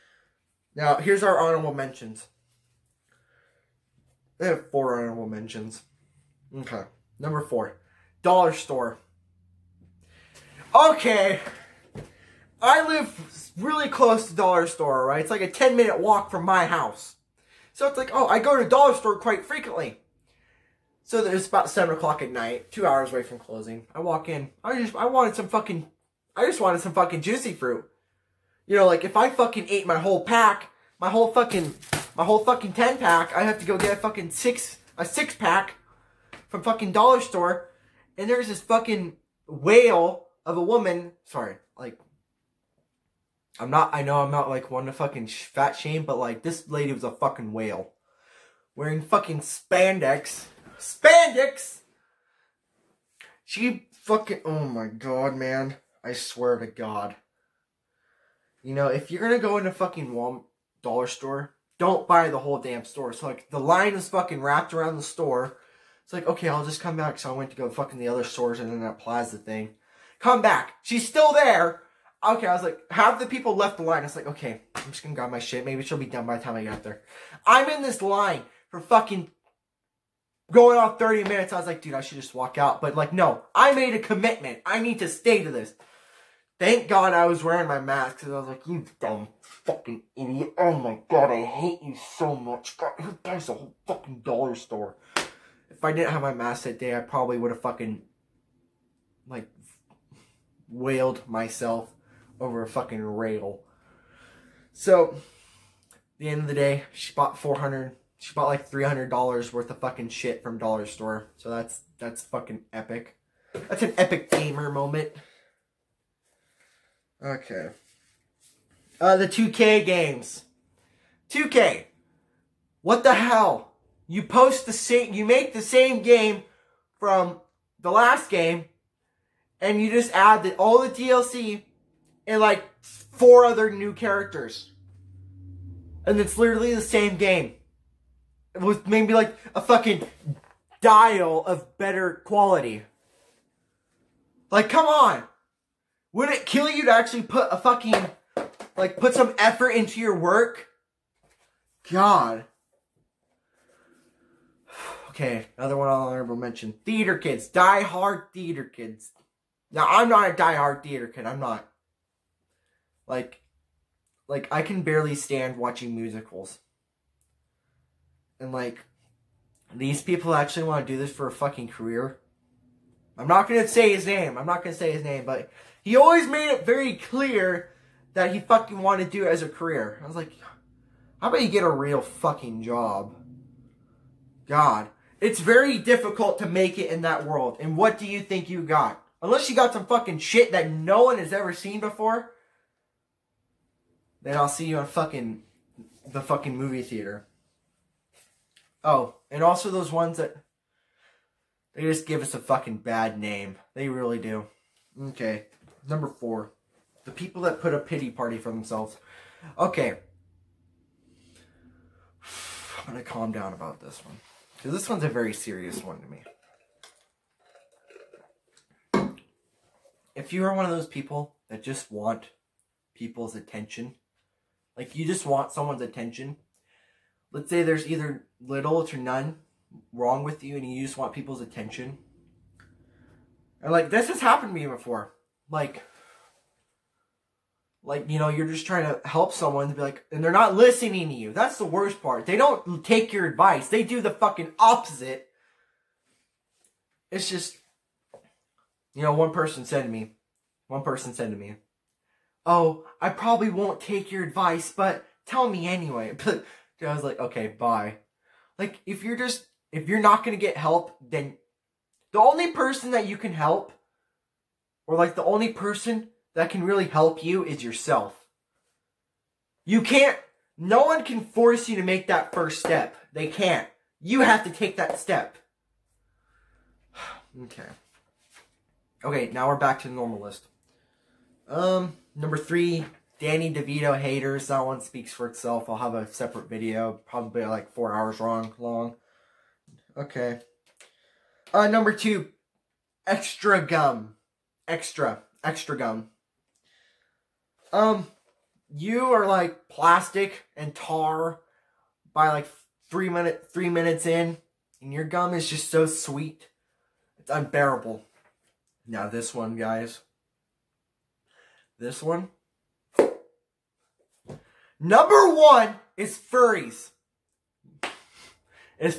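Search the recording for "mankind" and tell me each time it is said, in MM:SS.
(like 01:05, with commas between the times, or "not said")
not said.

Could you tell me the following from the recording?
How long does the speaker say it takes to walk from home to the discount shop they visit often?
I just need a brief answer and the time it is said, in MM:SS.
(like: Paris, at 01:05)
10 minutes, at 00:15.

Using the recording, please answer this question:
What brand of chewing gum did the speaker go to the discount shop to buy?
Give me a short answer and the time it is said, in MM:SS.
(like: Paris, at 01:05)
Juicy Fruit, at 00:27.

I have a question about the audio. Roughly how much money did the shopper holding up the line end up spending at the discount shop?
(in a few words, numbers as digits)
$300.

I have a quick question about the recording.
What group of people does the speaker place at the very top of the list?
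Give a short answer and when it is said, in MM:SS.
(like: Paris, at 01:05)
Furries, at 05:16.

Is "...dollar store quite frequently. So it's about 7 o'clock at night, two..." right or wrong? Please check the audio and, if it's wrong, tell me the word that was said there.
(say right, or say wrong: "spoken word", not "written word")
right.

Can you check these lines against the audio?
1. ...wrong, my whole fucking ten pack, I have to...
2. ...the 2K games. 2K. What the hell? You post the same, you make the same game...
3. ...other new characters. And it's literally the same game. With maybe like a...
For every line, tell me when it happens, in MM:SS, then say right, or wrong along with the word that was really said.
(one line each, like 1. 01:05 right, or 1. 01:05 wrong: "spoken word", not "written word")
1. 00:31 wrong: "fucking", not "wrong"
2. 01:59 right
3. 02:13 right.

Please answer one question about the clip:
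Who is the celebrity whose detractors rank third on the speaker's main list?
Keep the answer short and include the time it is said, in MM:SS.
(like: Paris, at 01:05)
Danny DeVito, at 04:43.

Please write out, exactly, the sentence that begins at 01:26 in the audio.
Thank God I was wearing my mask because I was like, you dumb fucking idiot.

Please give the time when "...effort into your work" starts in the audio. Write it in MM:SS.
02:29.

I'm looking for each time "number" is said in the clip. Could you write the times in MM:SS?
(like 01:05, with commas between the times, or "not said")
00:07, 03:25, 04:42, 04:51, 05:14.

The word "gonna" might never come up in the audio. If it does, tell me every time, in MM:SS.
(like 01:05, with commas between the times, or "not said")
00:59, 01:15, 04:20.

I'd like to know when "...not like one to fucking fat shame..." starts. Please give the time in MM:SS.
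00:44.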